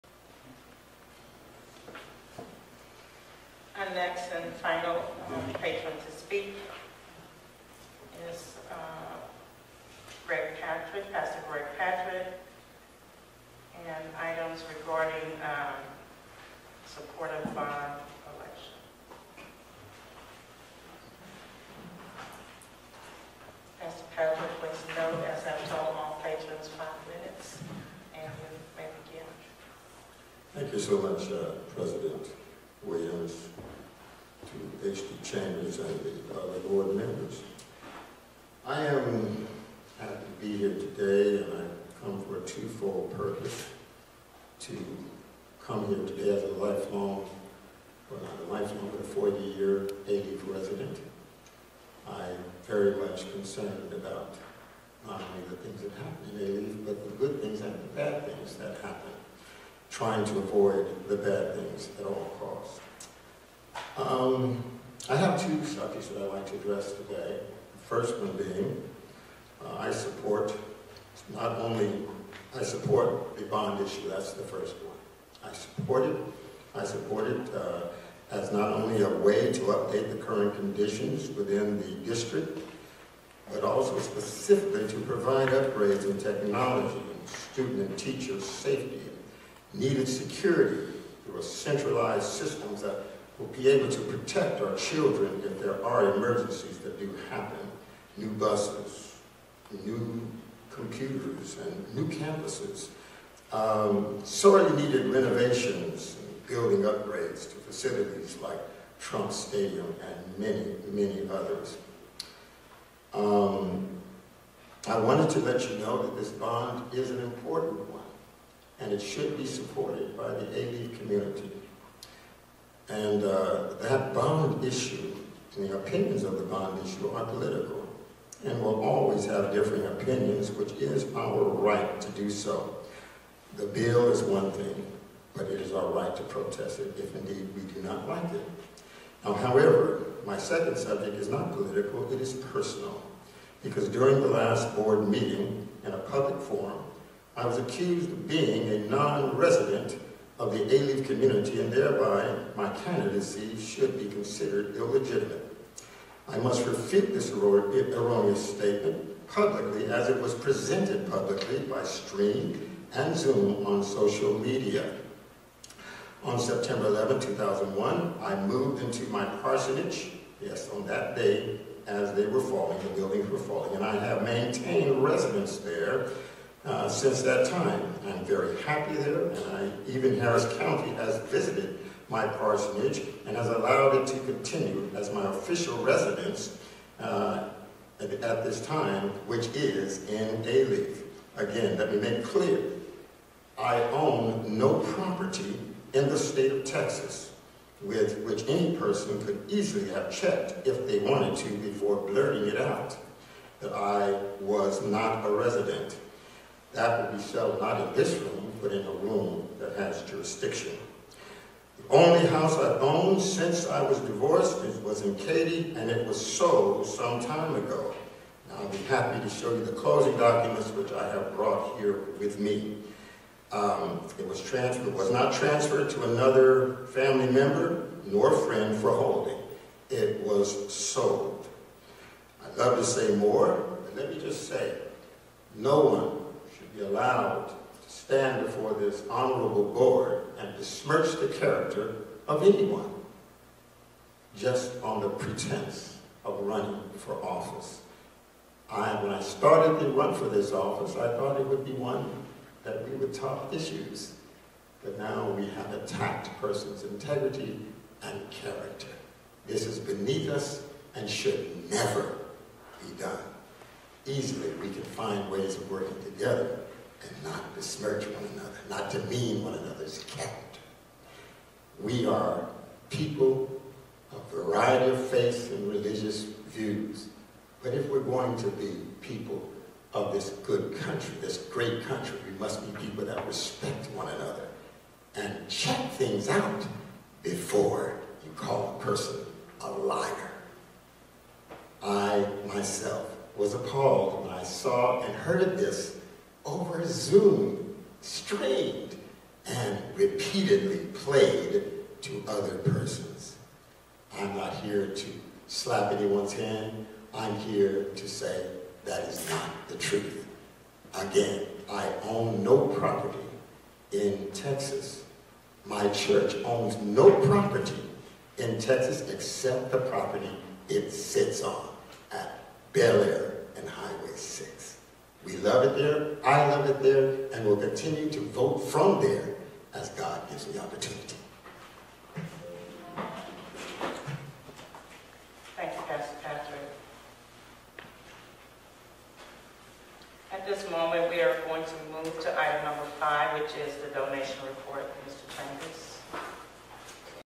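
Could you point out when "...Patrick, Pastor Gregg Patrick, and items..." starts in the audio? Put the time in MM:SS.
00:10.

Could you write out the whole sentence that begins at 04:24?
Easily, we can find ways of working together and not besmirch one another, not demean one another's character.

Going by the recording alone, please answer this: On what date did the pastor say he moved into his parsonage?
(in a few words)
September 11, 2001.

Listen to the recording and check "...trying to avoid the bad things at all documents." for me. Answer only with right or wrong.
wrong.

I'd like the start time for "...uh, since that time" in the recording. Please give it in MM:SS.
02:56.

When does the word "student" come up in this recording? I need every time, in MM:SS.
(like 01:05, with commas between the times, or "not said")
01:27.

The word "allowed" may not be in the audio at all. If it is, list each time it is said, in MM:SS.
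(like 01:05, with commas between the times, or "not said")
03:03, 03:56.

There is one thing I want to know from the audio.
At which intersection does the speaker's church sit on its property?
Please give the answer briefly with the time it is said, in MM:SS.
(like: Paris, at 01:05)
Bellaire and Highway 6, at 05:22.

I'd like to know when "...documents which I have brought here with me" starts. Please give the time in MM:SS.
03:40.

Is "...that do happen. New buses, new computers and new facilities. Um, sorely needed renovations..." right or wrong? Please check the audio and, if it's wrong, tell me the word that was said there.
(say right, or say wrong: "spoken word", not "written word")
wrong: "campuses", not "facilities".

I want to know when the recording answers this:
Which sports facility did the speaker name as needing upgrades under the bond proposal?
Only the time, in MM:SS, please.
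01:48.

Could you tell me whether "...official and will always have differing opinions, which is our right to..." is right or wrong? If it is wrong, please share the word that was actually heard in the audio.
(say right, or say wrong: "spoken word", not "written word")
wrong: "political", not "official".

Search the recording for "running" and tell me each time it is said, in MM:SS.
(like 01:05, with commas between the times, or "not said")
04:06.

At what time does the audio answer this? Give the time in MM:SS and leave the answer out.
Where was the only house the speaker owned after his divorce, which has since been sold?
03:35.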